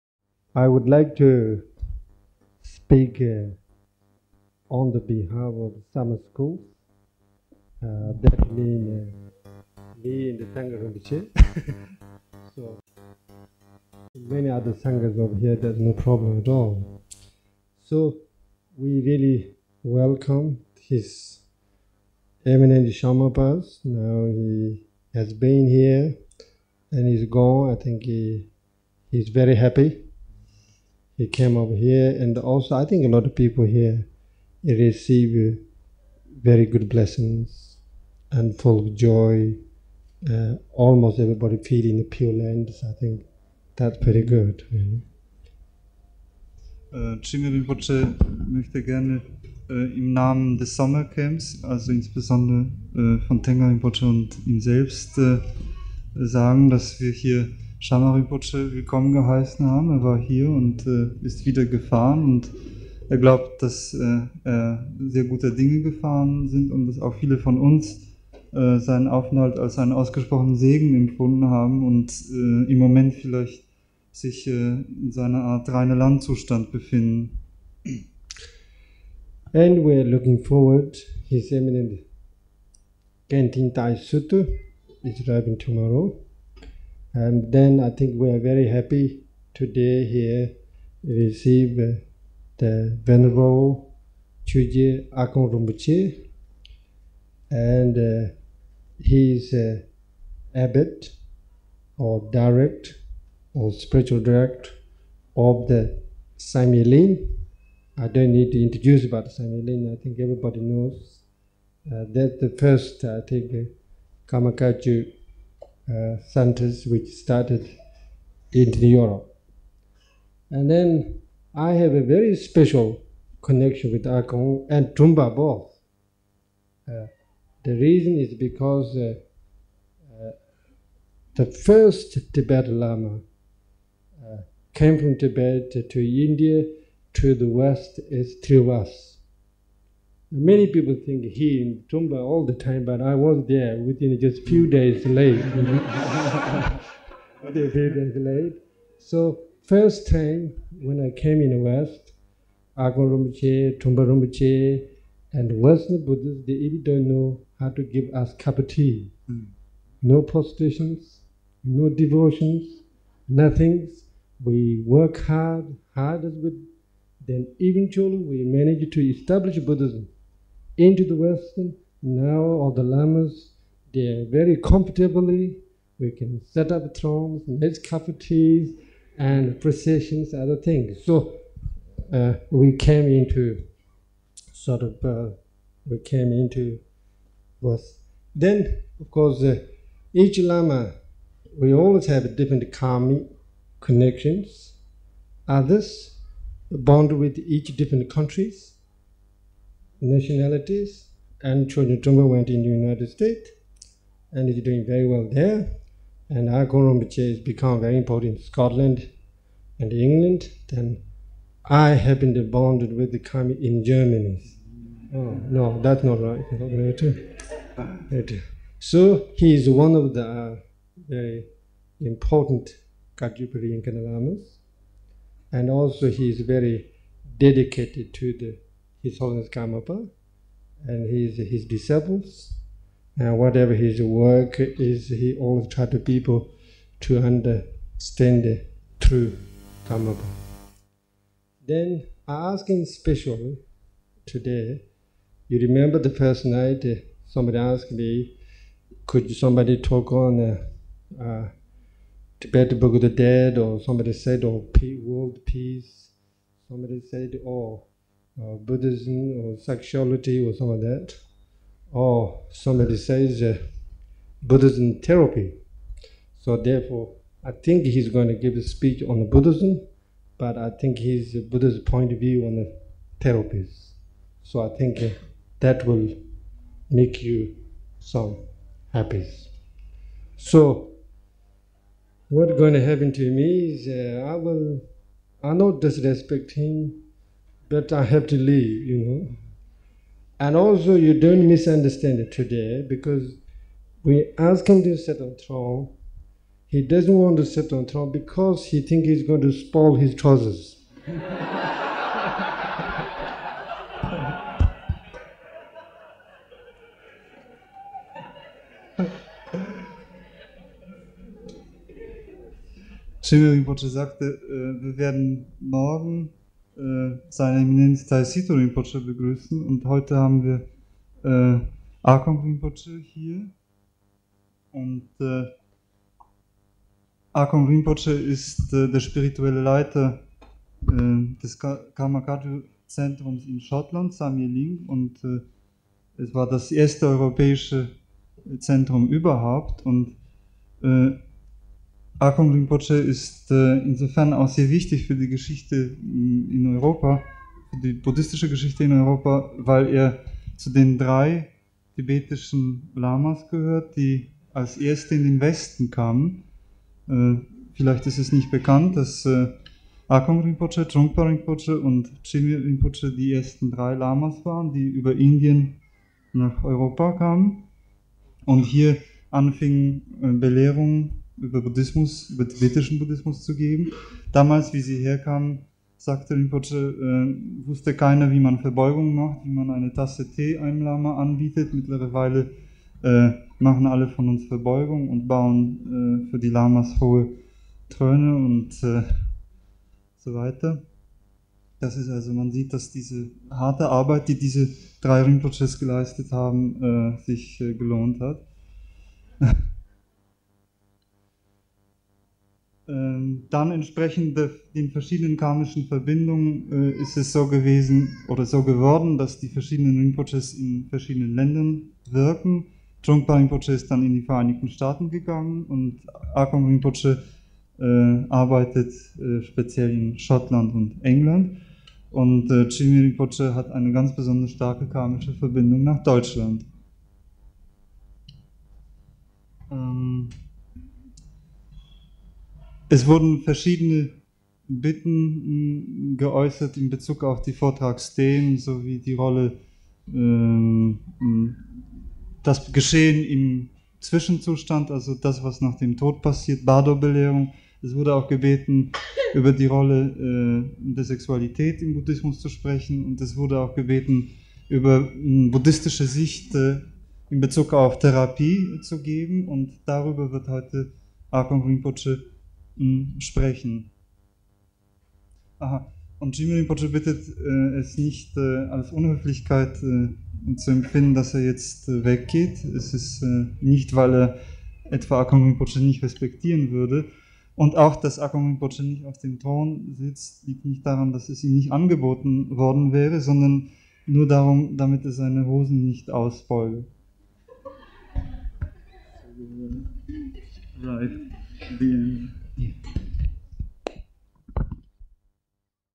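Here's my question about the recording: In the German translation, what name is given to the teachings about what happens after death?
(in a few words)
Bardo-Belehrung.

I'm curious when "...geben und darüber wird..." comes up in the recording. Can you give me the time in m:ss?
7:39.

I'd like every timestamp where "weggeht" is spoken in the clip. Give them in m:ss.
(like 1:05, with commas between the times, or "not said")
7:52.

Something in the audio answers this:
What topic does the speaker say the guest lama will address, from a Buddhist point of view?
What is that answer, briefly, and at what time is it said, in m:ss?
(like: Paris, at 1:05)
therapies, at 4:33.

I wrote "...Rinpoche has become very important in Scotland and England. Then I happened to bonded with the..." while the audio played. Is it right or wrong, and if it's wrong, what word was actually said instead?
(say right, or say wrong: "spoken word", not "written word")
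right.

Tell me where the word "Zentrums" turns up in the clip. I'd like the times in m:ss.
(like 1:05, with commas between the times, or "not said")
5:32, 5:38.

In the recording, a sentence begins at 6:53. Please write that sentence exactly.
Trungpa Rinpoche ist dann in die Vereinigten Staaten gegangen und Akon Rinpoche äh, arbeitet äh, speziell in Schottland und England.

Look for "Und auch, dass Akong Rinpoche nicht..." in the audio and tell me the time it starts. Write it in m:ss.
7:57.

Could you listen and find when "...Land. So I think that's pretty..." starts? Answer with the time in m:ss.
0:42.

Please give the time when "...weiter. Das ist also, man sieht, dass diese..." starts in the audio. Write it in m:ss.
6:30.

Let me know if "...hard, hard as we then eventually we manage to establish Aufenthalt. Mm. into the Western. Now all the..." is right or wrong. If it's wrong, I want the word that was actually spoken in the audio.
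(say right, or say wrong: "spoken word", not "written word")
wrong: "Buddhism", not "Aufenthalt".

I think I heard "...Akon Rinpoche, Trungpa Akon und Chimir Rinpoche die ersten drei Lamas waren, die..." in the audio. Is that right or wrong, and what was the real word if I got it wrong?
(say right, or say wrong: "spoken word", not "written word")
wrong: "Rinpoche", not "Akon".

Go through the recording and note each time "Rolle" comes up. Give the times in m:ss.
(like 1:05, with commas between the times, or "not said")
7:19, 7:29.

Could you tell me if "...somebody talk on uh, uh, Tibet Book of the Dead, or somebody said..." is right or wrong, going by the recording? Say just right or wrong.
right.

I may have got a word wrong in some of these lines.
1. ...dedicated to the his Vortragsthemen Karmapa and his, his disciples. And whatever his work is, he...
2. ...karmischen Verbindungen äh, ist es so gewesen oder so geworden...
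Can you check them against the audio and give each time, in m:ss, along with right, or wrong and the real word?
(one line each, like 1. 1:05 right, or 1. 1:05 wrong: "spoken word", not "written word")
1. 3:47 wrong: "Holiness", not "Vortragsthemen"
2. 6:45 right.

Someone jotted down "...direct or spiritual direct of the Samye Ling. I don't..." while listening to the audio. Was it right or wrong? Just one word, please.
right.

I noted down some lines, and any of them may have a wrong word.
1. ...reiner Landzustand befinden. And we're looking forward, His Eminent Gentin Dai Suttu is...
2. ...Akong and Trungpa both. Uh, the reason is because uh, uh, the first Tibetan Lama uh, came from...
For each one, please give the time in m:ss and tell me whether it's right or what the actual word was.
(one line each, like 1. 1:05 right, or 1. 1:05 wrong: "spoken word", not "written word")
1. 1:15 right
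2. 2:04 right.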